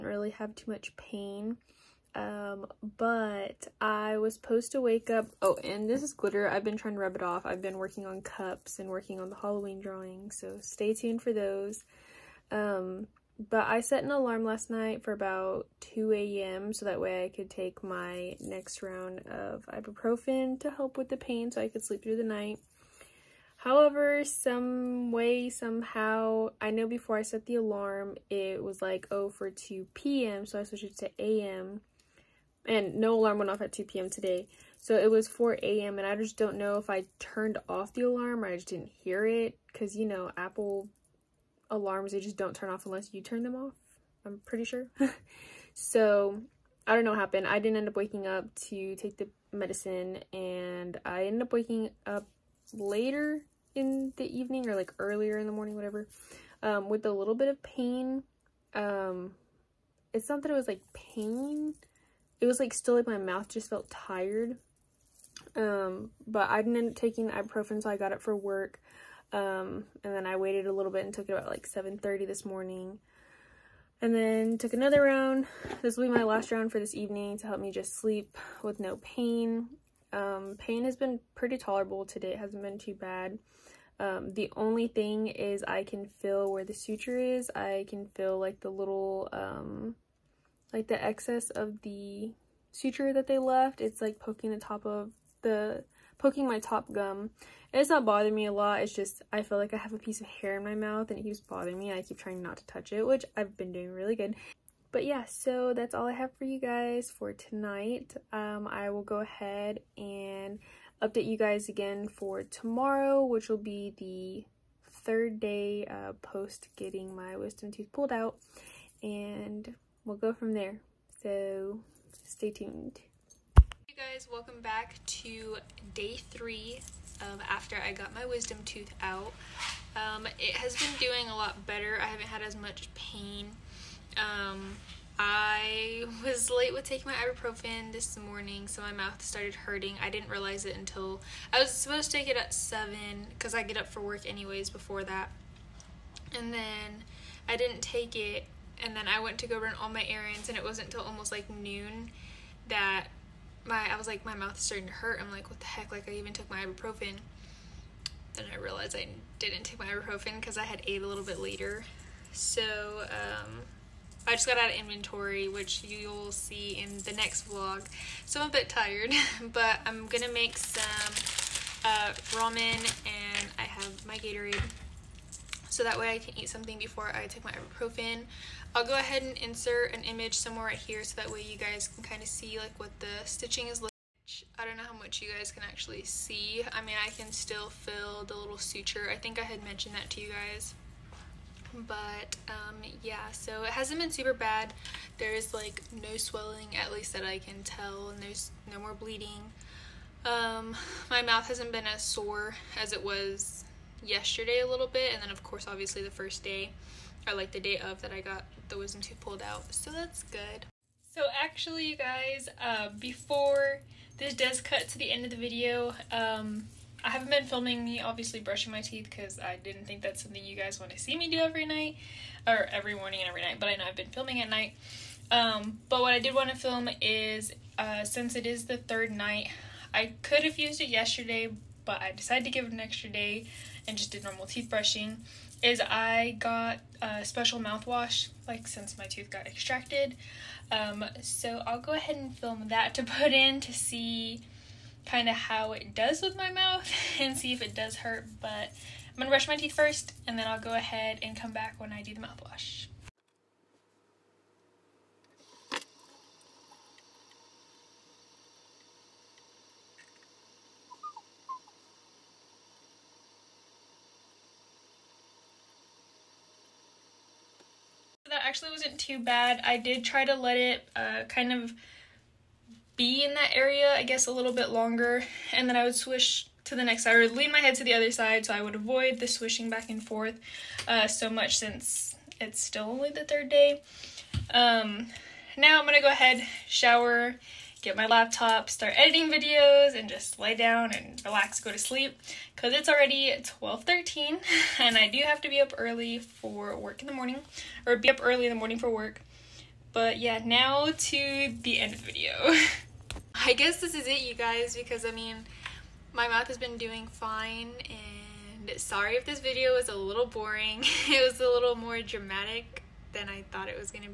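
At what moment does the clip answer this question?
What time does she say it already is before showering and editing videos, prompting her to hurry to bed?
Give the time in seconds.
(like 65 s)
293 s.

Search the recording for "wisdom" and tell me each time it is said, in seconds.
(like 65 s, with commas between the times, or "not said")
117 s, 128 s, 208 s.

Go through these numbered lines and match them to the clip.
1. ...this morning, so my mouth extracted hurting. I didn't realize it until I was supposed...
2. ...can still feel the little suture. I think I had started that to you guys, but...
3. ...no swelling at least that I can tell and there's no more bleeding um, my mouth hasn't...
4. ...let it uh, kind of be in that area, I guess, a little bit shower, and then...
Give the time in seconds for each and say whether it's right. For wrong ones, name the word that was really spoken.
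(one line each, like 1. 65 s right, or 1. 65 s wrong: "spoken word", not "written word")
1. 137 s wrong: "started", not "extracted"
2. 187 s wrong: "mentioned", not "started"
3. 196 s right
4. 270 s wrong: "longer", not "shower".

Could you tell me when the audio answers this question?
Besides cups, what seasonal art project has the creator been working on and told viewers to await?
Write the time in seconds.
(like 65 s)
9 s.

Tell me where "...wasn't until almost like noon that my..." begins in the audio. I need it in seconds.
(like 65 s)
150 s.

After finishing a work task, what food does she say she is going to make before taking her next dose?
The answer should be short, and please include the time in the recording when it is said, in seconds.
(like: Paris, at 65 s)
ramen, at 172 s.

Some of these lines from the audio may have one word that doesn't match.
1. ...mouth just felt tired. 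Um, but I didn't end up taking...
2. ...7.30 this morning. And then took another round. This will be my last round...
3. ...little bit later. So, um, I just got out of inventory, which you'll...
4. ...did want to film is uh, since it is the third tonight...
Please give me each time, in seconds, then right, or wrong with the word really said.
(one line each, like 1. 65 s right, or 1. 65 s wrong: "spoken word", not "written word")
1. 63 s right
2. 71 s right
3. 161 s right
4. 226 s wrong: "night", not "tonight".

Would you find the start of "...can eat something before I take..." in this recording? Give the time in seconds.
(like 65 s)
176 s.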